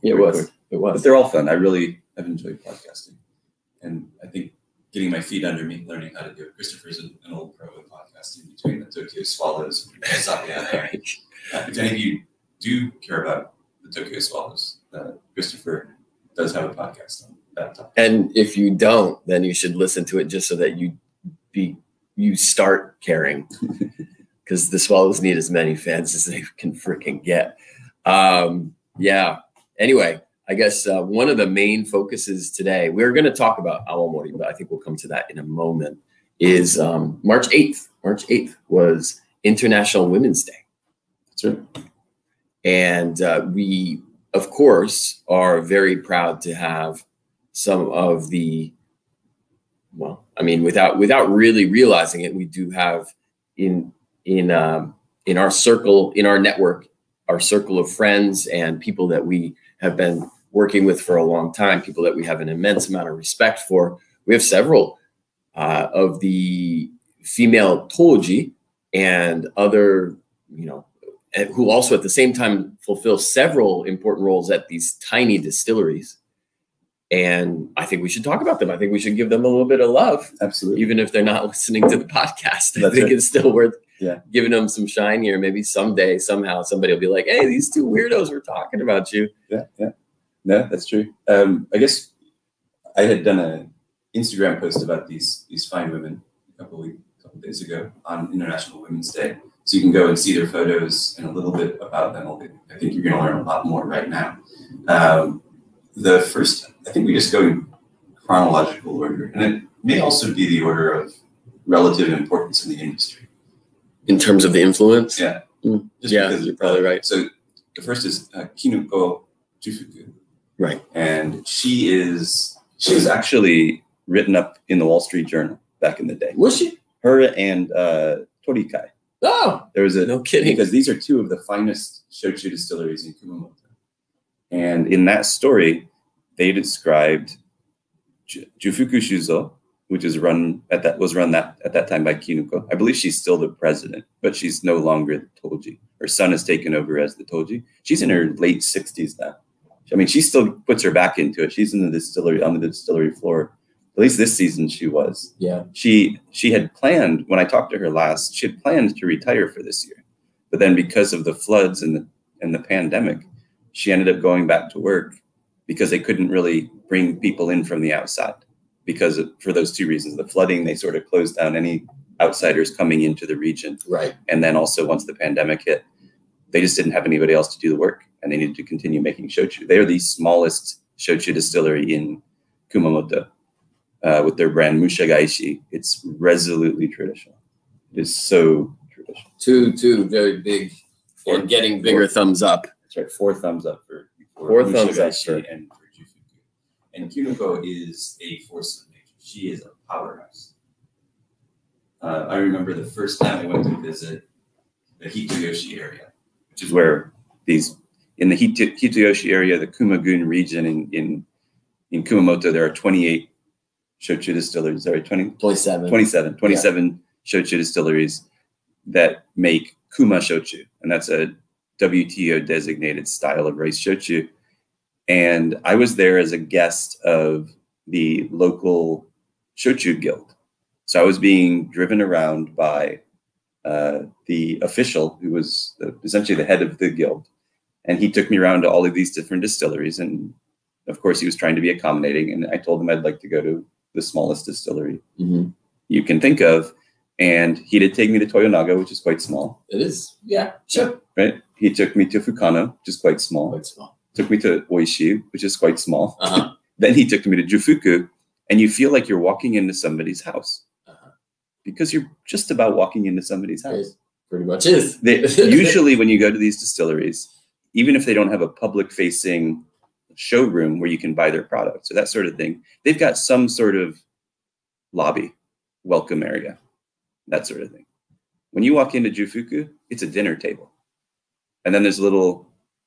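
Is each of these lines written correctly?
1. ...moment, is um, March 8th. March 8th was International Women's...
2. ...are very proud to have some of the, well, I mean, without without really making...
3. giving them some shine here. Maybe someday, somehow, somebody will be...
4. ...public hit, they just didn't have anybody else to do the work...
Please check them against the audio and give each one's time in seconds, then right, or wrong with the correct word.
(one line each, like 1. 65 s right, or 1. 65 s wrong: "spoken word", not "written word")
1. 35 s right
2. 45 s wrong: "realizing", not "making"
3. 84 s right
4. 175 s wrong: "pandemic", not "public".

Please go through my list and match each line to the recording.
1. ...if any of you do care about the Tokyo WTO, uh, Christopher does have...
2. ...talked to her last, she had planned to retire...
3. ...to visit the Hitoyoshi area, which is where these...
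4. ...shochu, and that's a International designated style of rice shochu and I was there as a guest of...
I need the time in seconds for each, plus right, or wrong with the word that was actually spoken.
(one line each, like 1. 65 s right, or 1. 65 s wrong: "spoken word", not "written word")
1. 10 s wrong: "Swallows", not "WTO"
2. 157 s right
3. 203 s right
4. 220 s wrong: "WTO", not "International".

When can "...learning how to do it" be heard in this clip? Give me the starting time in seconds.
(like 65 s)
5 s.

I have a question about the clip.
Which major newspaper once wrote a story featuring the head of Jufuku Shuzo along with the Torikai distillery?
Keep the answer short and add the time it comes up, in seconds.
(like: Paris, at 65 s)
Wall Street Journal, at 124 s.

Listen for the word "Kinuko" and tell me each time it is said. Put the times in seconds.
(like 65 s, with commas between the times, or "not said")
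118 s, 142 s, 197 s.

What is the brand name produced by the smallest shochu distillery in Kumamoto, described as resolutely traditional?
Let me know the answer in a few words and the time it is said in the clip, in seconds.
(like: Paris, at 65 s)
Mushagaeshi, at 184 s.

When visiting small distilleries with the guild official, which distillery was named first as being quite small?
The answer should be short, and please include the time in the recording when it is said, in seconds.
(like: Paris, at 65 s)
Toyonaga, at 248 s.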